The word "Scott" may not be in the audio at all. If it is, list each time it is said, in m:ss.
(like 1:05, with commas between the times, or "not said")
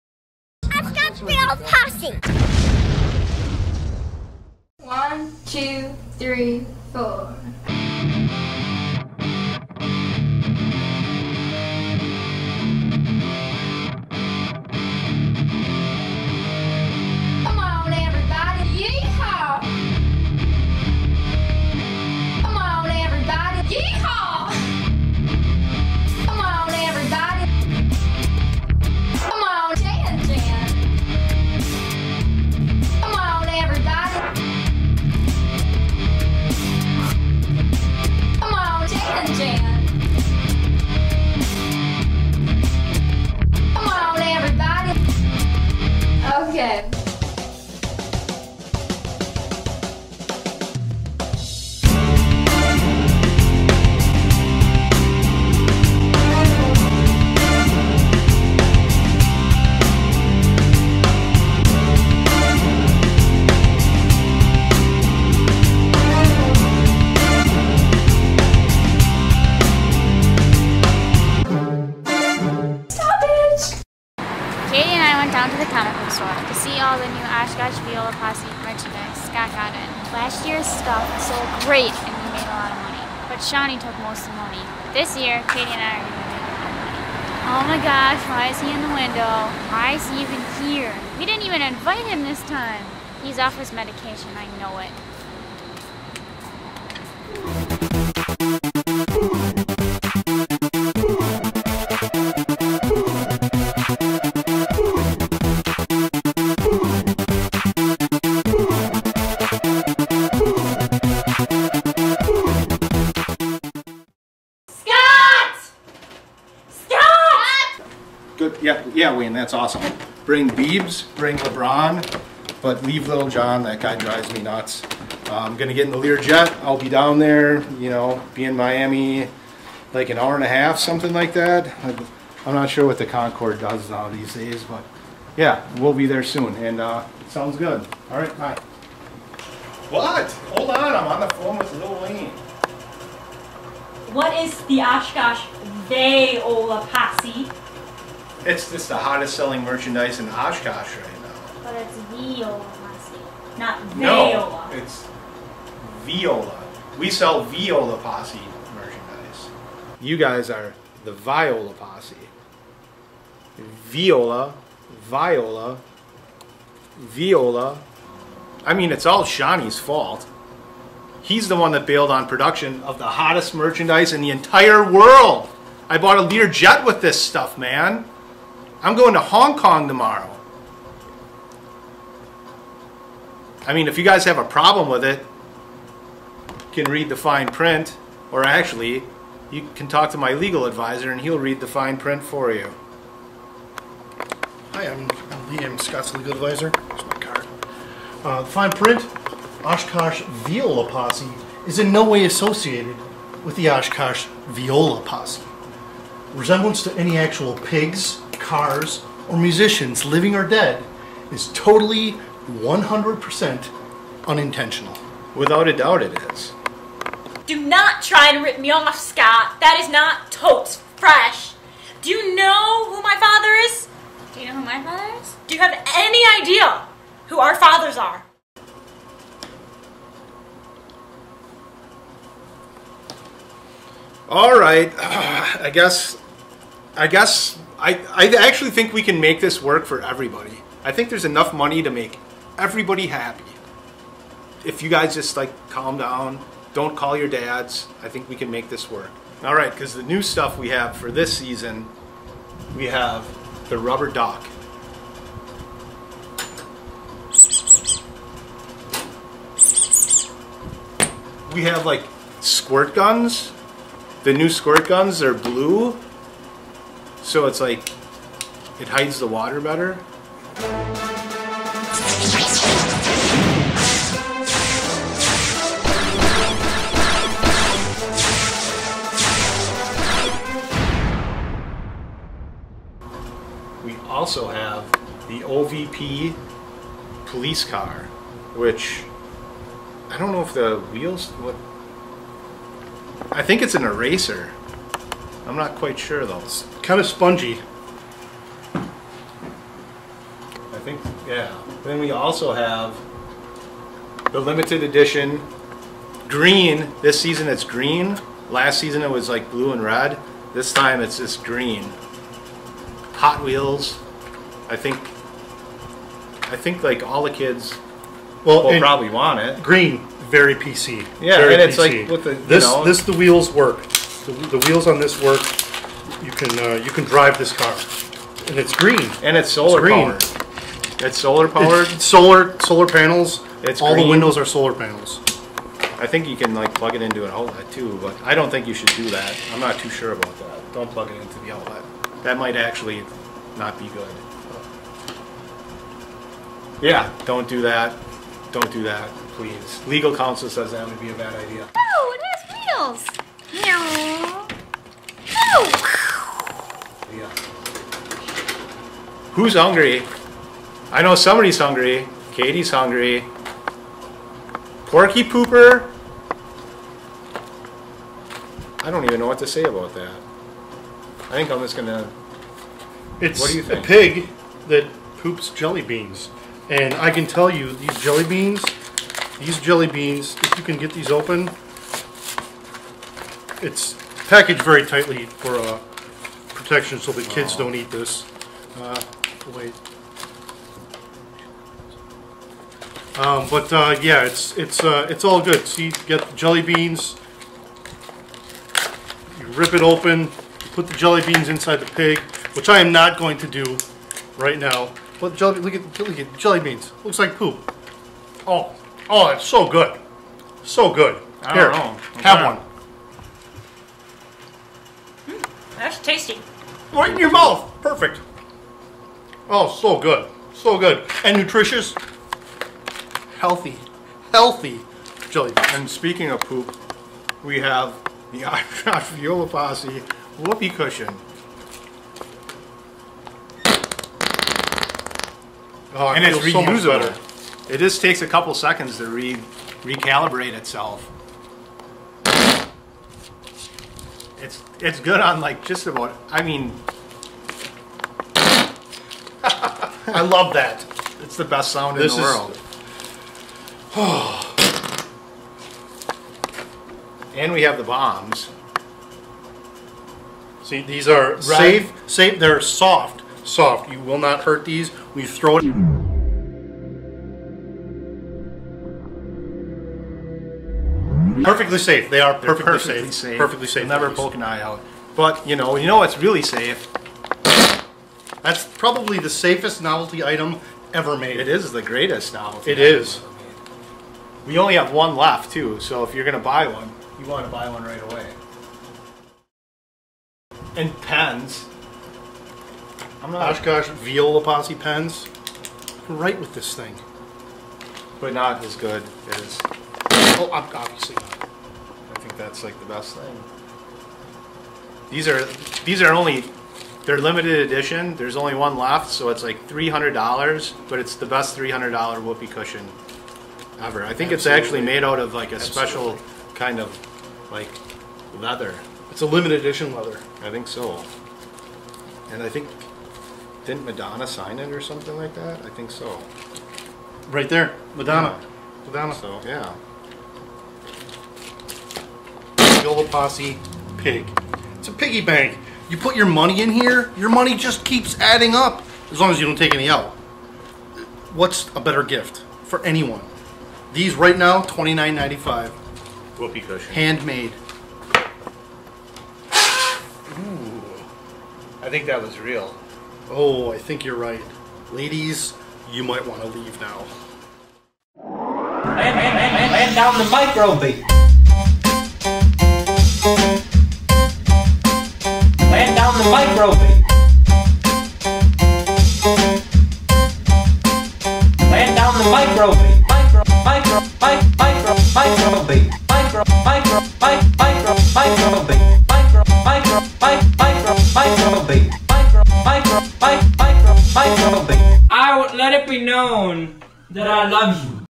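1:19, 3:15, 3:38.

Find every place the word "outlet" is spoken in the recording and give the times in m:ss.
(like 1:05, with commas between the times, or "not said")
5:37, 5:41.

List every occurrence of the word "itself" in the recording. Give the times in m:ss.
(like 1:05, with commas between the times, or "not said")
7:20.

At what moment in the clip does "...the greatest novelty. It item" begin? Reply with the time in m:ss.
8:01.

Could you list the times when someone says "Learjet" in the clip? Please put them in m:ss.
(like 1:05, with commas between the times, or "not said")
2:05, 2:56.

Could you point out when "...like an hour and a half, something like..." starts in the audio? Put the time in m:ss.
2:09.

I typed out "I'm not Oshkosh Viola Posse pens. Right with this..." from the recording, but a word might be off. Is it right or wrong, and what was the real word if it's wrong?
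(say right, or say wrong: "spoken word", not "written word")
right.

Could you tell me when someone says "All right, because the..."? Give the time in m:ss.
4:09.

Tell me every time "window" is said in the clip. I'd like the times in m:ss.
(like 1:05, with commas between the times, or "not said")
1:28, 5:34.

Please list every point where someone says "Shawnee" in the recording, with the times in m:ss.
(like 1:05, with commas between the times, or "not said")
1:23, 2:49.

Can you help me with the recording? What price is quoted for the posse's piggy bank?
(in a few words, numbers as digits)
$29.95.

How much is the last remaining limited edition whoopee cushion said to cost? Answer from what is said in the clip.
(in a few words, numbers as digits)
$300.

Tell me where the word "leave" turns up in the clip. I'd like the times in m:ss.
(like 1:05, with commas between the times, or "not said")
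2:02, 9:16.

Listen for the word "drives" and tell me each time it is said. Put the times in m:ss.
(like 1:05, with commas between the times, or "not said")
2:03, 5:27.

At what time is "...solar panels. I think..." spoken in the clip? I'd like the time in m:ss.
5:34.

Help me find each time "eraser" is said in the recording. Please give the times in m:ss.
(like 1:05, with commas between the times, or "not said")
4:53.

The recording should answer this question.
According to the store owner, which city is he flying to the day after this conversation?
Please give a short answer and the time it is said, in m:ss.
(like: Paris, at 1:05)
Hong Kong, at 2:59.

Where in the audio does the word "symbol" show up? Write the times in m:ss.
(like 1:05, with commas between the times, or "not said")
not said.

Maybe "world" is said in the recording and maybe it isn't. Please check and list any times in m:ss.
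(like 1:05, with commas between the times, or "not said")
2:54, 7:32.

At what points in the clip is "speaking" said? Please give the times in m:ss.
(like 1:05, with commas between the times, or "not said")
7:05.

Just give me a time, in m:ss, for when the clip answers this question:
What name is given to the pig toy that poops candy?
6:04.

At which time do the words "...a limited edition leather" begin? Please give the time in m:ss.
8:39.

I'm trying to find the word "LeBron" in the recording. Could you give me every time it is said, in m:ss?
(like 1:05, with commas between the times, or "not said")
2:01.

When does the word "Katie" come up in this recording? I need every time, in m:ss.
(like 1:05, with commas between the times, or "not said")
1:25, 6:02.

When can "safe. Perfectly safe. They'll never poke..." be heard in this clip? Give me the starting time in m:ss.
7:53.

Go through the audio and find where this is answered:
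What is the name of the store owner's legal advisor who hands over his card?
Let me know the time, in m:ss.
3:15.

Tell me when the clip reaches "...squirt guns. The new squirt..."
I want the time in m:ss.
4:22.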